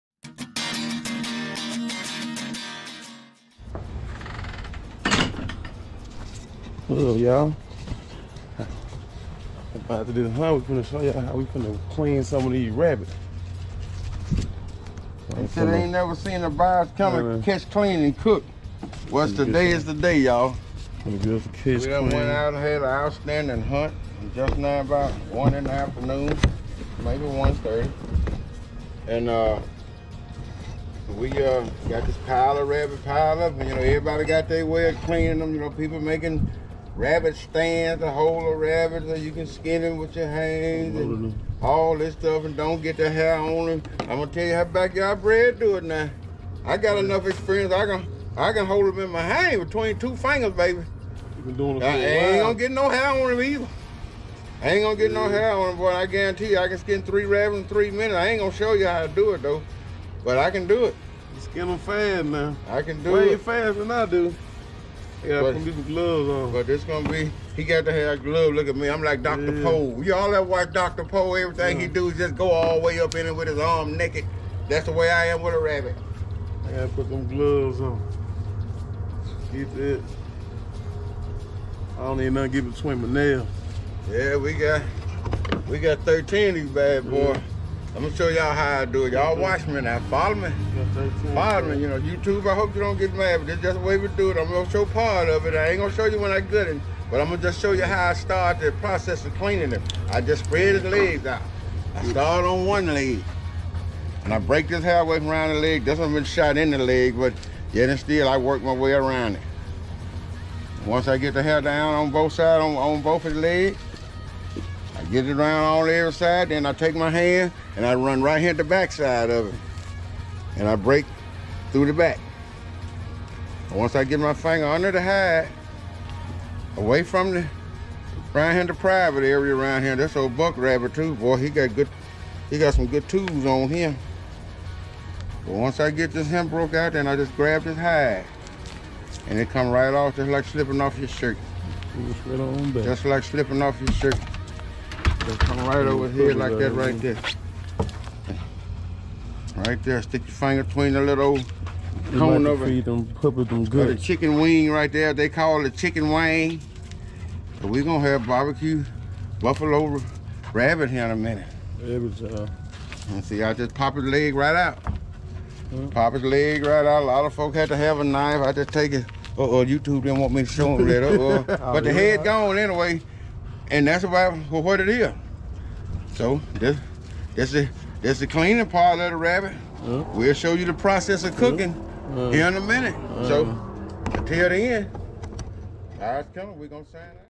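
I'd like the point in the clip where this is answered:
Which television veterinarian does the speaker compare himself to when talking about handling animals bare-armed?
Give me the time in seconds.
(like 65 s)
70 s.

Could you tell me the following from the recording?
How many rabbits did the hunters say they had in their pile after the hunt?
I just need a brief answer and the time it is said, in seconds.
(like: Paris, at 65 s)
13, at 85 s.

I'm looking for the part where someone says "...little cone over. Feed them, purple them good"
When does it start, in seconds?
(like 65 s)
151 s.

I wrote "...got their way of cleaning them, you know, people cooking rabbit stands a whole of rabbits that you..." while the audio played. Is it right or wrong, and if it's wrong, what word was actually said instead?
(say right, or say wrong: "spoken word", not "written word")
wrong: "making", not "cooking".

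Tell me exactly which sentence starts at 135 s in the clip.
But once I get this hem broke out, then I just grab this hide.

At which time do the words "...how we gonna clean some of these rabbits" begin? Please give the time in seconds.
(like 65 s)
11 s.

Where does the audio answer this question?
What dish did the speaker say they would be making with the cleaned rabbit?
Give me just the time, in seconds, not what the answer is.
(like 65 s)
158 s.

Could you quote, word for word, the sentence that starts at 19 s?
What's the day is the day, y'all.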